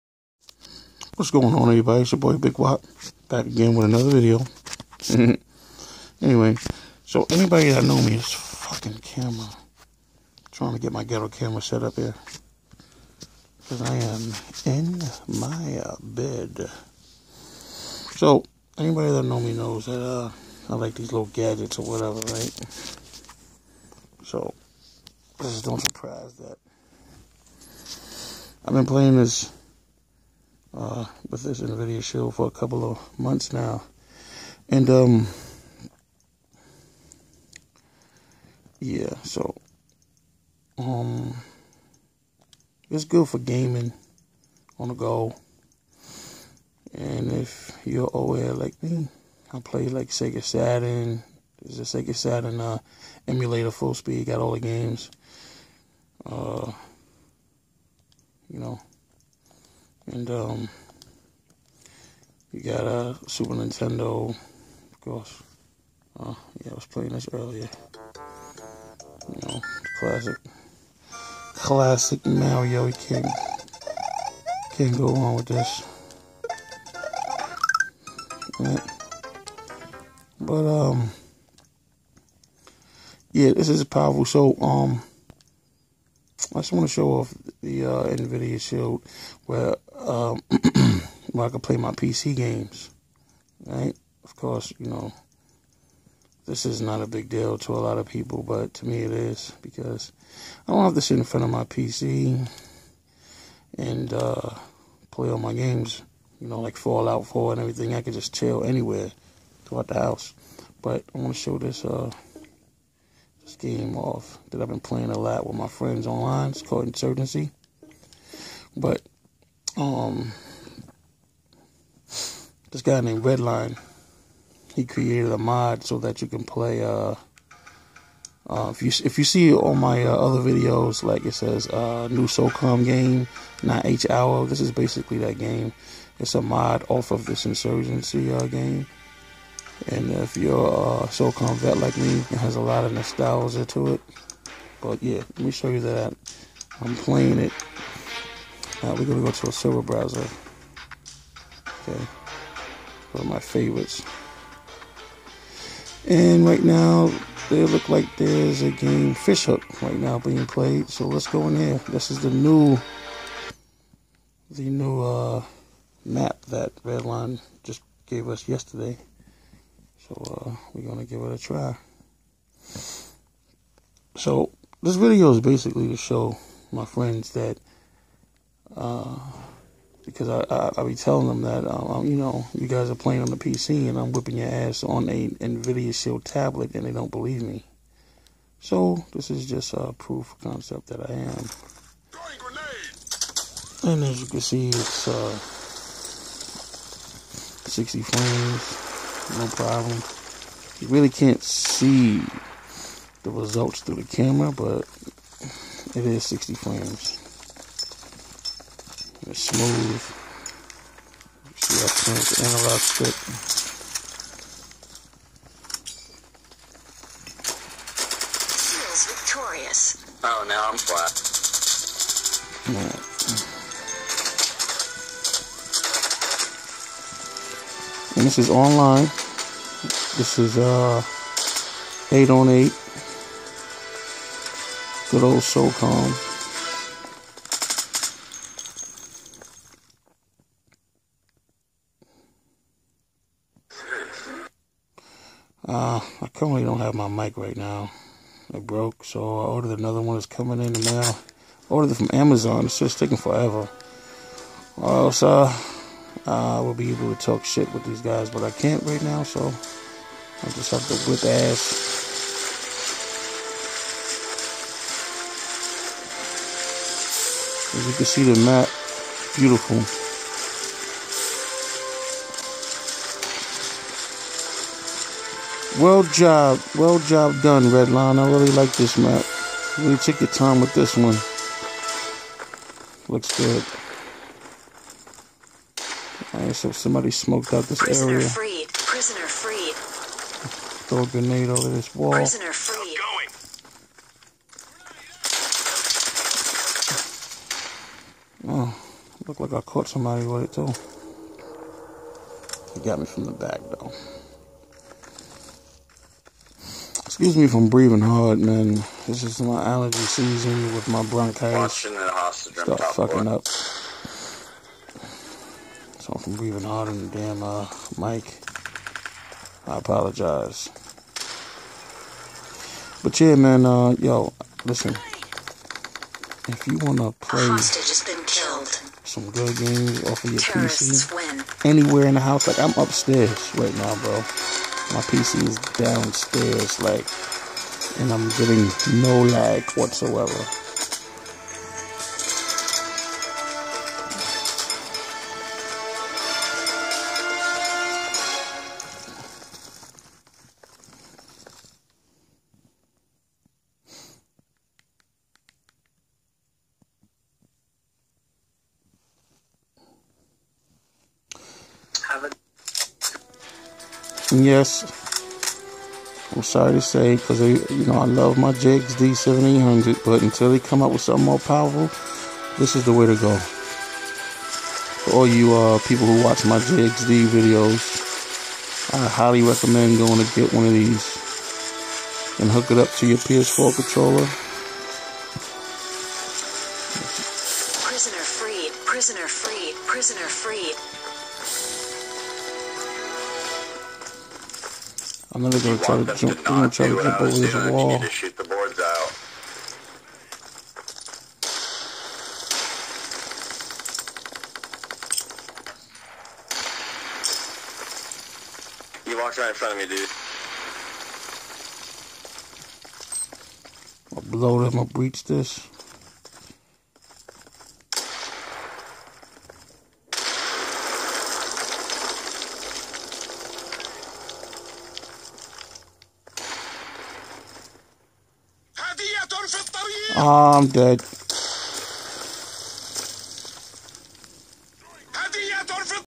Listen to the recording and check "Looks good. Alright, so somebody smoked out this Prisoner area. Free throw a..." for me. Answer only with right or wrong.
right.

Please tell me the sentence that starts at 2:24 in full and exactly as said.
But yeah, let me show you that.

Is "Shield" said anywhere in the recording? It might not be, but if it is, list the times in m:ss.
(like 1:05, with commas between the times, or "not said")
1:28, 3:05.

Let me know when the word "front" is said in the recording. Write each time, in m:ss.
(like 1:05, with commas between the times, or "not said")
1:41, 6:49.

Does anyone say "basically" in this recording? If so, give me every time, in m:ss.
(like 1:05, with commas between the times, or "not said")
2:14, 2:55.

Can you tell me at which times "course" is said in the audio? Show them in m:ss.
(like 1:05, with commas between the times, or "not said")
1:05, 1:34.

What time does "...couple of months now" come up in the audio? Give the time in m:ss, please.
0:32.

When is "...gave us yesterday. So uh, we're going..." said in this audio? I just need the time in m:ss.
2:48.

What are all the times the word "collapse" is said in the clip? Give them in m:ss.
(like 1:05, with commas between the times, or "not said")
not said.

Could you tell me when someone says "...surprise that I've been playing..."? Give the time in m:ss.
0:25.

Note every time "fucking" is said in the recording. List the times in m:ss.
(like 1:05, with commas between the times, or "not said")
0:08, 5:12.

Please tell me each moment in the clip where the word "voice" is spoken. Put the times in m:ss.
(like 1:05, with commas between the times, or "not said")
not said.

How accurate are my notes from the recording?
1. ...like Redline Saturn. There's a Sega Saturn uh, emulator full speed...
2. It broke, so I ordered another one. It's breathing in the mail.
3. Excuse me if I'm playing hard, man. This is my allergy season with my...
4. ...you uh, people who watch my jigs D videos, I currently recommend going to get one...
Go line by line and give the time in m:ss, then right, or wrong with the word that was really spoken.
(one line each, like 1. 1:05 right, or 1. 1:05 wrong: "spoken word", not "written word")
1. 0:49 wrong: "Sega", not "Redline"
2. 4:08 wrong: "coming", not "breathing"
3. 5:07 wrong: "breathing", not "playing"
4. 6:15 wrong: "highly", not "currently".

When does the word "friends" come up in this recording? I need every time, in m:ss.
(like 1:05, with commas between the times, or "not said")
1:55, 2:56.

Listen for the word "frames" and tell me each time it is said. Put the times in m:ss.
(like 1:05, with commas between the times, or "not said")
3:18, 3:26.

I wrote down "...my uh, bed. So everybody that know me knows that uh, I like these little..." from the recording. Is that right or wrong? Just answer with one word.
wrong.